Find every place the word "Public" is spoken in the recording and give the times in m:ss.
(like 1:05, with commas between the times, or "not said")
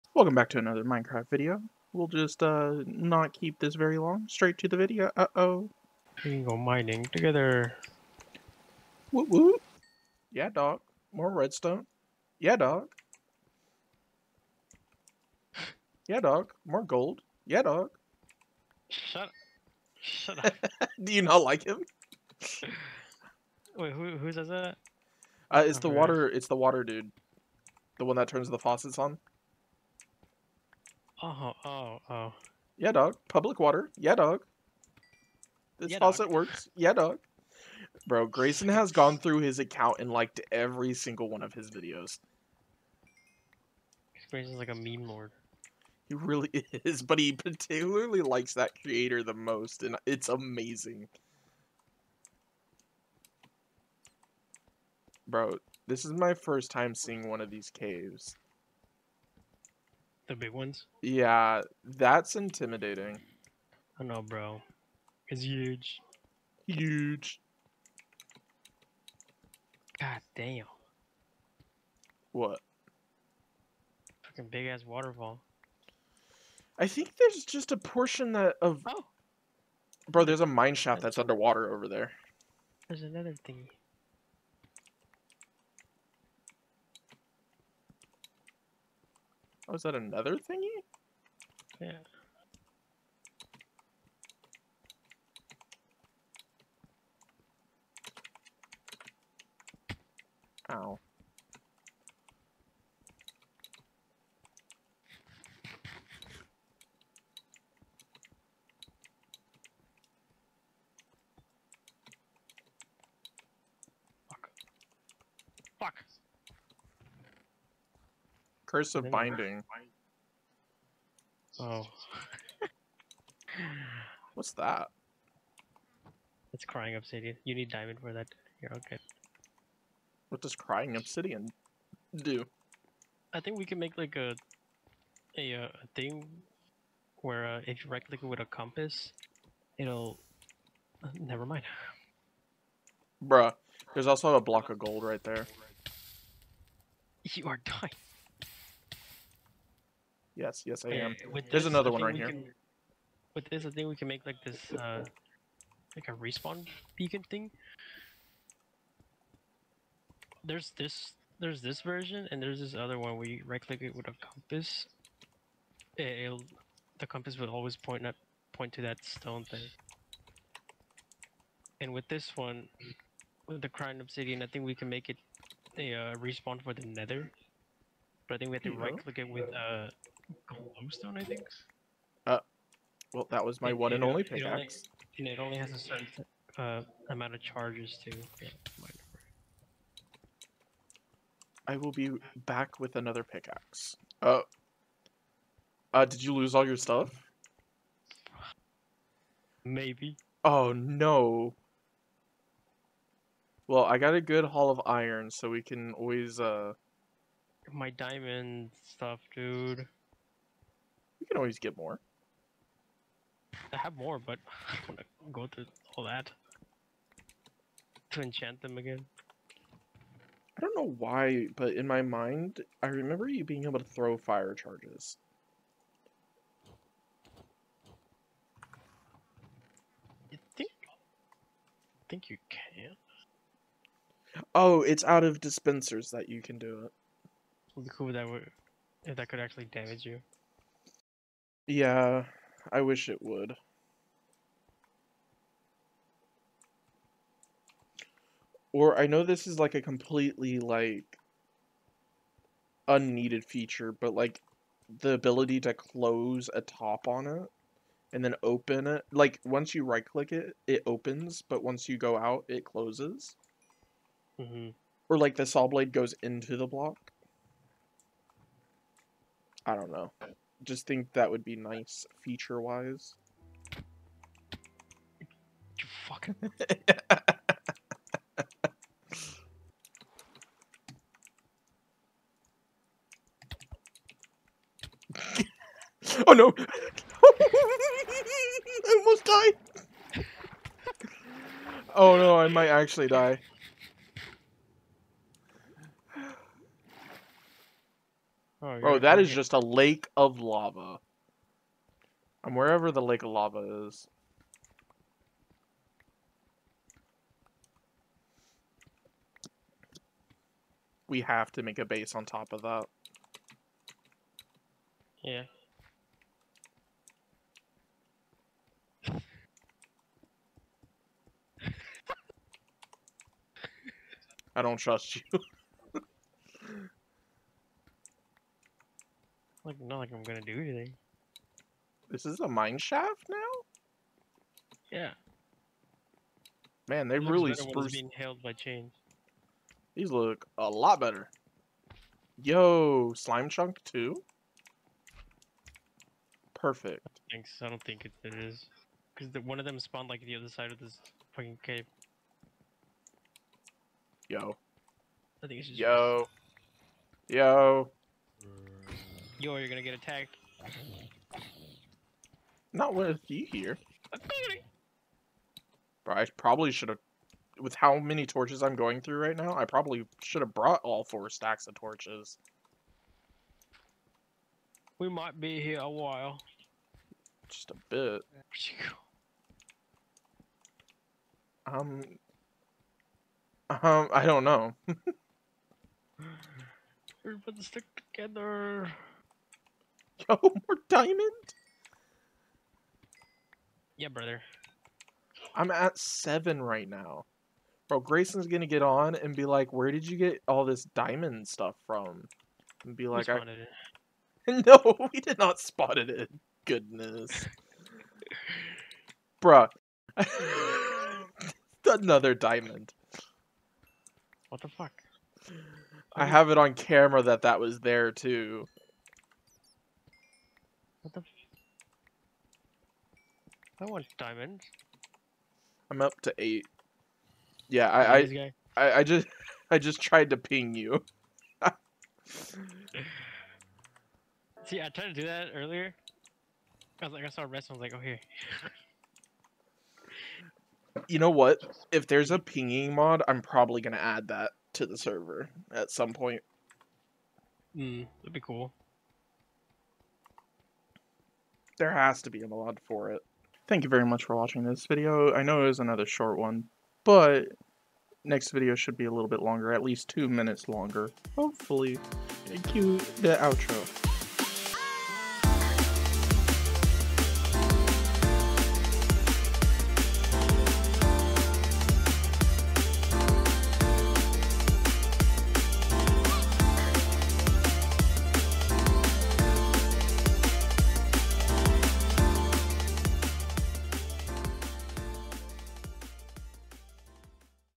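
0:33.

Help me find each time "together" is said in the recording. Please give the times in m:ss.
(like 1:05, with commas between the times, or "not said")
0:07, 6:28.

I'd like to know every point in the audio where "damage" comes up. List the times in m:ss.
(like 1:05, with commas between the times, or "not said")
3:59.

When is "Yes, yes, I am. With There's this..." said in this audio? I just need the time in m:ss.
2:30.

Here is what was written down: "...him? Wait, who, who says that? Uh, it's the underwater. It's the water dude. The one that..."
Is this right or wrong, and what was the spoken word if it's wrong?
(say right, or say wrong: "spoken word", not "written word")
wrong: "water", not "underwater".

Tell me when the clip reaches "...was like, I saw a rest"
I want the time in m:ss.
7:17.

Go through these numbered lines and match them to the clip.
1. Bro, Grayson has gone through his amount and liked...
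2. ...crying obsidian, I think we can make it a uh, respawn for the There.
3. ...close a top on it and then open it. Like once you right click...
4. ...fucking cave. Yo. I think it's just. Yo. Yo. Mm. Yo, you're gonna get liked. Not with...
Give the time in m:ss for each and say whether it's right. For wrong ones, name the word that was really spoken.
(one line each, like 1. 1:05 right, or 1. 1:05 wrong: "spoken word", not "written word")
1. 0:38 wrong: "account", not "amount"
2. 2:53 wrong: "Nether", not "There"
3. 4:15 right
4. 5:51 wrong: "attacked", not "liked".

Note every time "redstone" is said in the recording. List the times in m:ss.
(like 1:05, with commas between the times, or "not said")
0:11.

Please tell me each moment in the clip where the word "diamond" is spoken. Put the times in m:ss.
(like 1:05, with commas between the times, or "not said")
2:07, 3:27, 6:30, 6:40, 6:52, 7:04.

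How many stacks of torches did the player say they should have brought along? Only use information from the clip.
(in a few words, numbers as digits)
4.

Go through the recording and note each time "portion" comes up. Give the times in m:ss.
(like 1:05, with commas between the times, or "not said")
1:17.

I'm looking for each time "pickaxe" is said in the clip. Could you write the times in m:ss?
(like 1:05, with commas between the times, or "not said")
3:04, 3:13.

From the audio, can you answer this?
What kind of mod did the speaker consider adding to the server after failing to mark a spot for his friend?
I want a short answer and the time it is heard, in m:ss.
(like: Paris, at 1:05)
A pinging mod, at 7:22.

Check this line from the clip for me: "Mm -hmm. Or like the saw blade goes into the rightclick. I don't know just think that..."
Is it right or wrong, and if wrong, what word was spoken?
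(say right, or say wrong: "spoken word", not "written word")
wrong: "block", not "rightclick".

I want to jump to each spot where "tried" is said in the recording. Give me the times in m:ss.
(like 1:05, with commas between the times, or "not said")
7:10, 7:14.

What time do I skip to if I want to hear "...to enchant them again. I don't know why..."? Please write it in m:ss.
3:38.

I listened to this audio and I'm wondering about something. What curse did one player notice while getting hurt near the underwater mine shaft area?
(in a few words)
Curse of binding.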